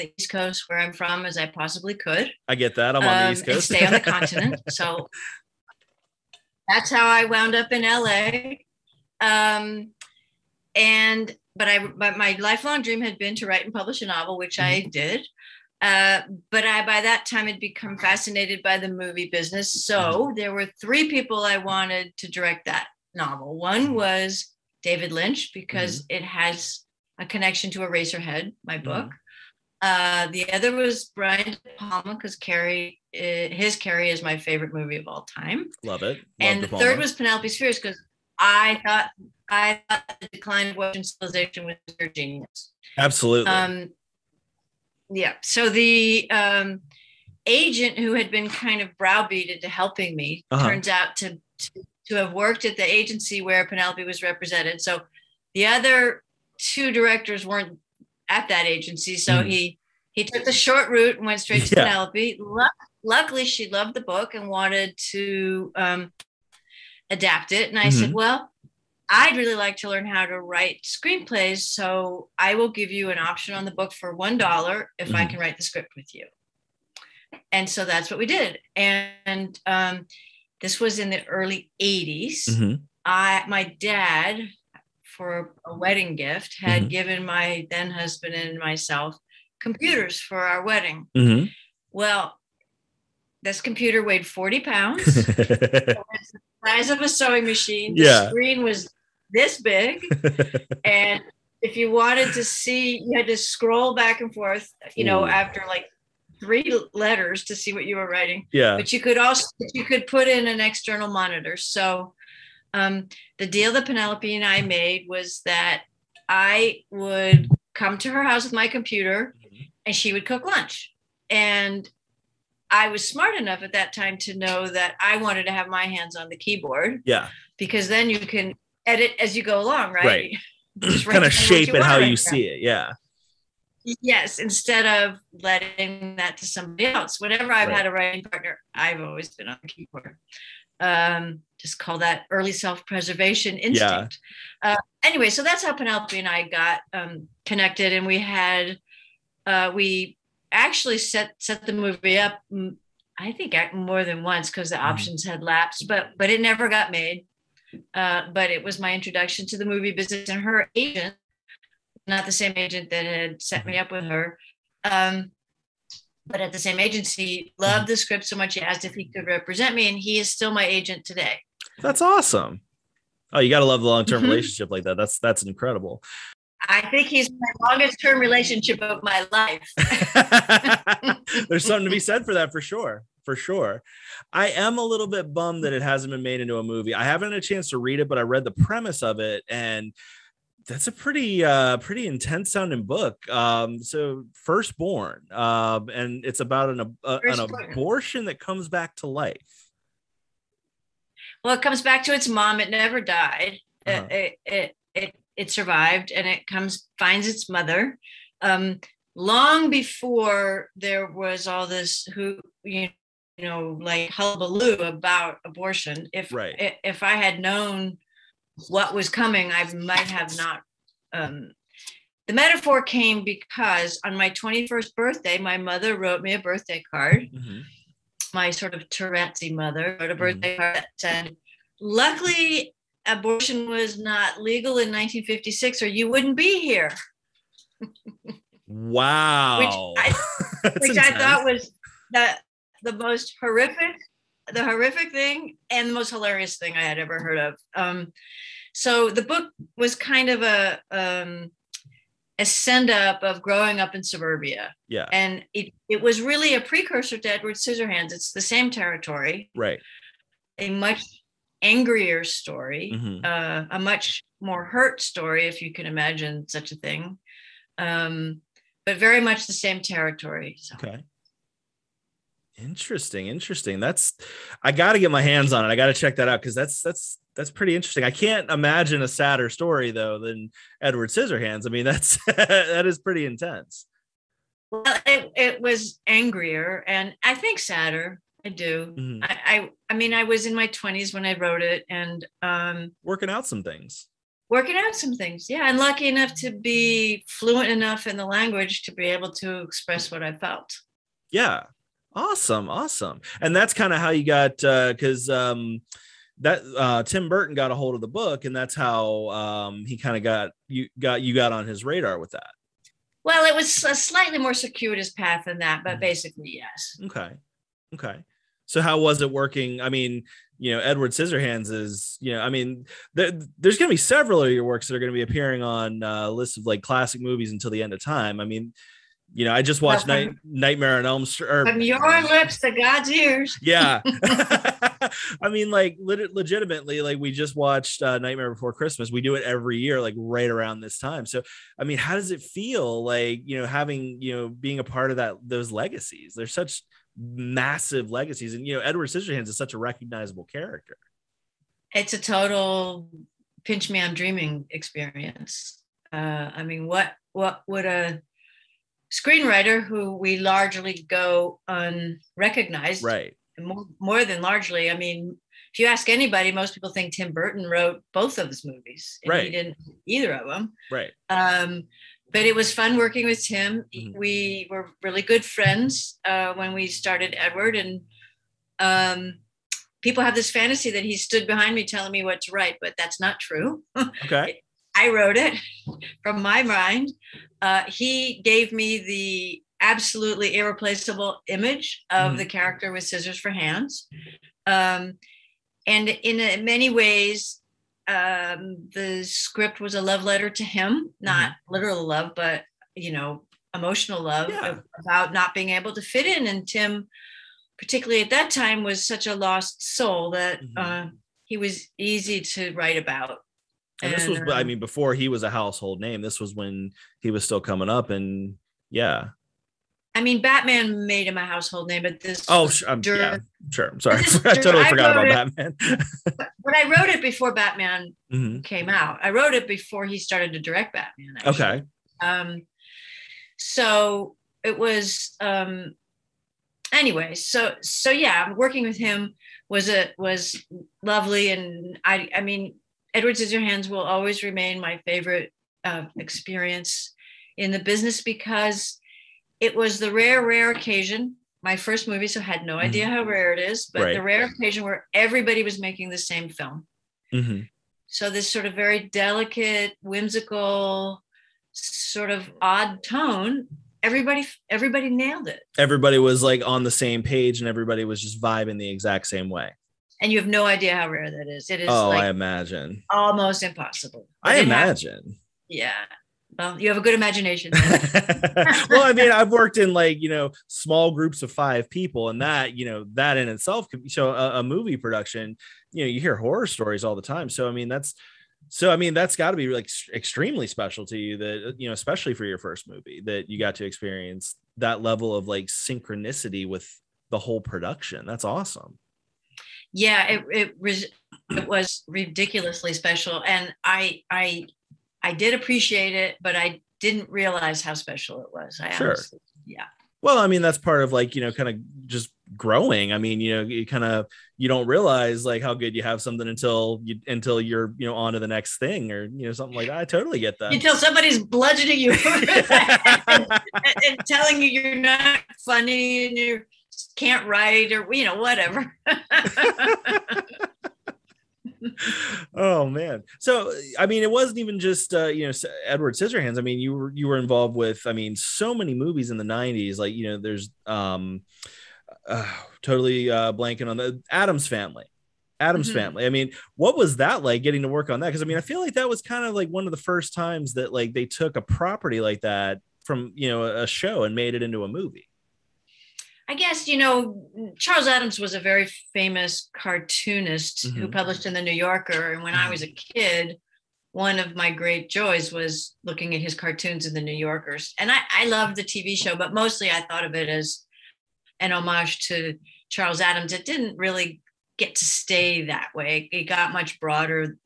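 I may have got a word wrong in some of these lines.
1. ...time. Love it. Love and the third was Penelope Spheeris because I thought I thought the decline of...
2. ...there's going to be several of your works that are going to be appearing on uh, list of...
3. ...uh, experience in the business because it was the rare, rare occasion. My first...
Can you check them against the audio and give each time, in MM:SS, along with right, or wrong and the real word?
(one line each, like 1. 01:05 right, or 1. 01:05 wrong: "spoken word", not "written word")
1. 00:35 right
2. 05:23 right
3. 07:25 right.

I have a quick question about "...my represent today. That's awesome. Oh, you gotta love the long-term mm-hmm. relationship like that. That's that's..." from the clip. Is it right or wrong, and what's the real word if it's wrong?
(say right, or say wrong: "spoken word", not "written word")
wrong: "agent", not "represent".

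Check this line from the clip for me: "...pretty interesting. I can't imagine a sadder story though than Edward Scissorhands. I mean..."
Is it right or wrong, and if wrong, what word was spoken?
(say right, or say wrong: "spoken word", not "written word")
right.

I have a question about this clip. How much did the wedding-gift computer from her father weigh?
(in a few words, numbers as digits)
40 pounds.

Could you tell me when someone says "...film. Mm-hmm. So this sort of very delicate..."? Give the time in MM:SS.
07:36.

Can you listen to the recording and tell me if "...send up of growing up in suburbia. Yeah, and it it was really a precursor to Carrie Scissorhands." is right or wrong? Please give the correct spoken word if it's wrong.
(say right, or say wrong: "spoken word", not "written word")
wrong: "Edward", not "Carrie".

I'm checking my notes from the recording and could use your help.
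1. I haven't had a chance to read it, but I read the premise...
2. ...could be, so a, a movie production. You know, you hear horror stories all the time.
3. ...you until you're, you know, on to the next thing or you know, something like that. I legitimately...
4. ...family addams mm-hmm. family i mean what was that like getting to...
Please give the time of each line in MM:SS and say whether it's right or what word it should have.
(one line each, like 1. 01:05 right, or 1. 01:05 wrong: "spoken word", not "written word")
1. 03:06 right
2. 08:03 right
3. 08:37 wrong: "totally", not "legitimately"
4. 09:04 right.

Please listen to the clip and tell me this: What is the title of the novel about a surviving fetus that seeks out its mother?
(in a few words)
Firstborn.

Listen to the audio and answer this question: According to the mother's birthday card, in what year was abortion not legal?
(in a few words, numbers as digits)
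1956.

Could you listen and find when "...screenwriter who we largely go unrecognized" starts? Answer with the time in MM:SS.
05:59.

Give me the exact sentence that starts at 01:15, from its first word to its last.
I can write the script with you.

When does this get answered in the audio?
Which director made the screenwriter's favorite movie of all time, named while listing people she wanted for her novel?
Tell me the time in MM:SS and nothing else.
00:31.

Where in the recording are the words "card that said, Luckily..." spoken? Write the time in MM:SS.
03:50.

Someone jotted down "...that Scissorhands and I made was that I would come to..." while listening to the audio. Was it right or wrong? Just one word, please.
wrong.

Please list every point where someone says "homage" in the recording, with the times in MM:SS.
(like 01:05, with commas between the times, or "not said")
09:31.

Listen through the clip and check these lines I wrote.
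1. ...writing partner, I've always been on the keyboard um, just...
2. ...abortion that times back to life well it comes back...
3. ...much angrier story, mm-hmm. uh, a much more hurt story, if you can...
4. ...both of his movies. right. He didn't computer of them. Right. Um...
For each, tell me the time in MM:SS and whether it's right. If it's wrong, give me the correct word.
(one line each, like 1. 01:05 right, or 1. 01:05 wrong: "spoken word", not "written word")
1. 02:17 right
2. 03:17 wrong: "comes", not "times"
3. 04:20 right
4. 06:08 wrong: "either", not "computer".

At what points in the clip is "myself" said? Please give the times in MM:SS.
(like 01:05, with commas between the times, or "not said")
01:28.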